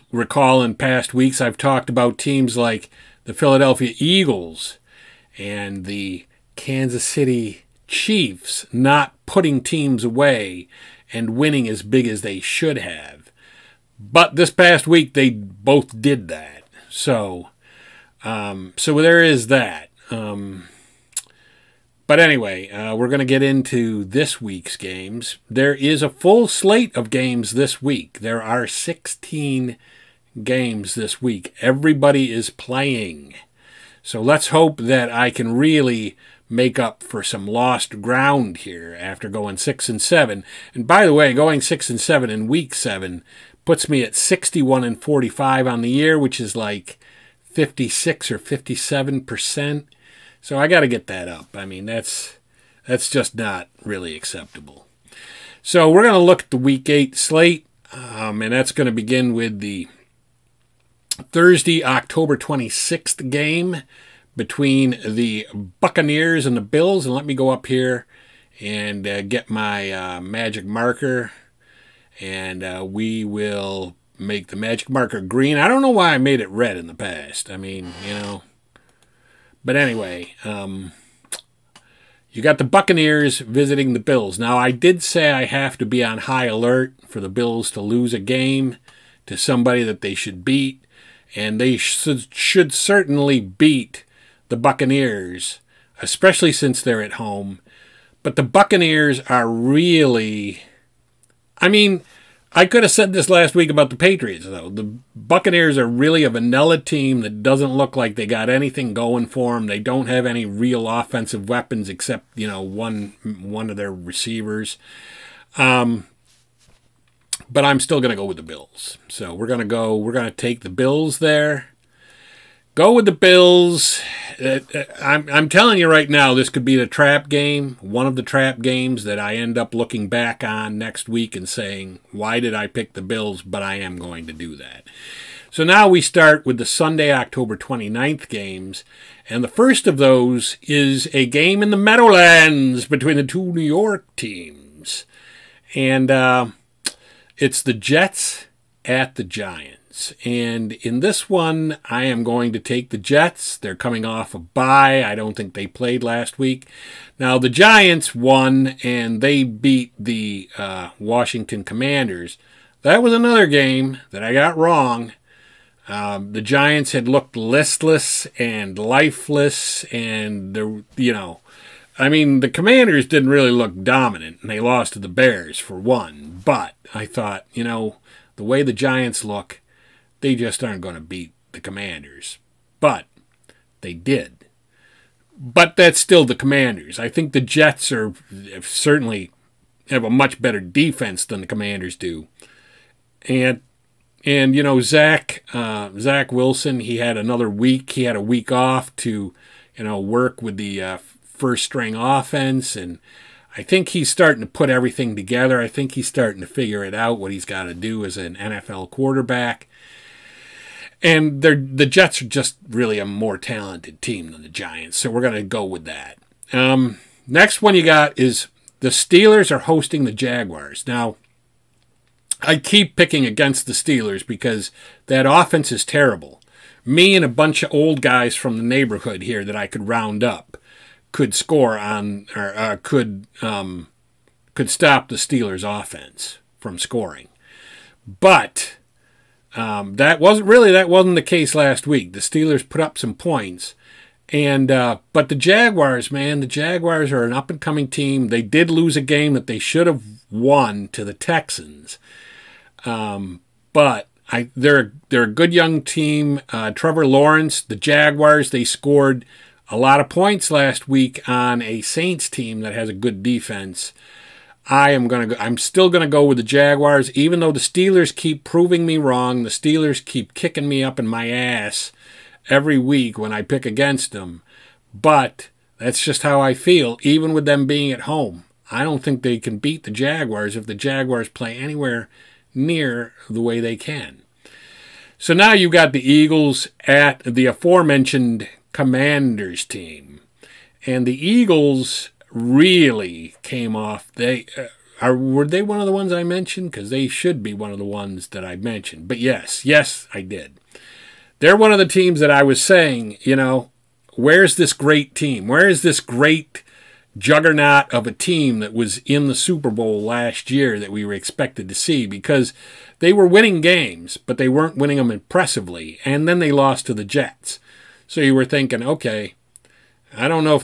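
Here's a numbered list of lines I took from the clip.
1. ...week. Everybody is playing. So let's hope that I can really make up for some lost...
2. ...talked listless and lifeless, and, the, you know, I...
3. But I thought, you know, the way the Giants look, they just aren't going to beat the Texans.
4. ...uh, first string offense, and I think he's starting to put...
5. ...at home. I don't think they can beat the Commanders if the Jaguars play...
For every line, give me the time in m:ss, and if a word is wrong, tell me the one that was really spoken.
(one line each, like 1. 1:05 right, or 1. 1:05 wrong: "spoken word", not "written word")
1. 0:31 right
2. 2:47 wrong: "looked", not "talked"
3. 2:56 wrong: "Commanders", not "Texans"
4. 3:20 right
5. 4:37 wrong: "Jaguars", not "Commanders".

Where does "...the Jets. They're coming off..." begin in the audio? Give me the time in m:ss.
2:32.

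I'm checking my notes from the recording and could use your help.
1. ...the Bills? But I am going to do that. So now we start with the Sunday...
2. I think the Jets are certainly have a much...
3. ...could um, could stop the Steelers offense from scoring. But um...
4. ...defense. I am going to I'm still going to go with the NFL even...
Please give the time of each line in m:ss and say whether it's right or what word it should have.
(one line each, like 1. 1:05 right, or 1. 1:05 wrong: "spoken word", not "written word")
1. 2:12 right
2. 3:06 right
3. 3:52 right
4. 4:23 wrong: "Jaguars", not "NFL".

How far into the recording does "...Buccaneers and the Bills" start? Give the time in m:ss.
1:05.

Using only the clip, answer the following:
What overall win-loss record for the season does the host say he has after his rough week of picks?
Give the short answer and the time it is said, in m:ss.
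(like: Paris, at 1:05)
61-45, at 0:44.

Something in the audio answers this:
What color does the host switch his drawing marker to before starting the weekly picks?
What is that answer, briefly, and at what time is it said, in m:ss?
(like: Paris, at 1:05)
green, at 1:15.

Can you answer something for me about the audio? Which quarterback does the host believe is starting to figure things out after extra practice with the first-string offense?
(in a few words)
Zach Wilson.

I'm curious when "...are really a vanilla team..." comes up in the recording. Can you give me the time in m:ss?
1:45.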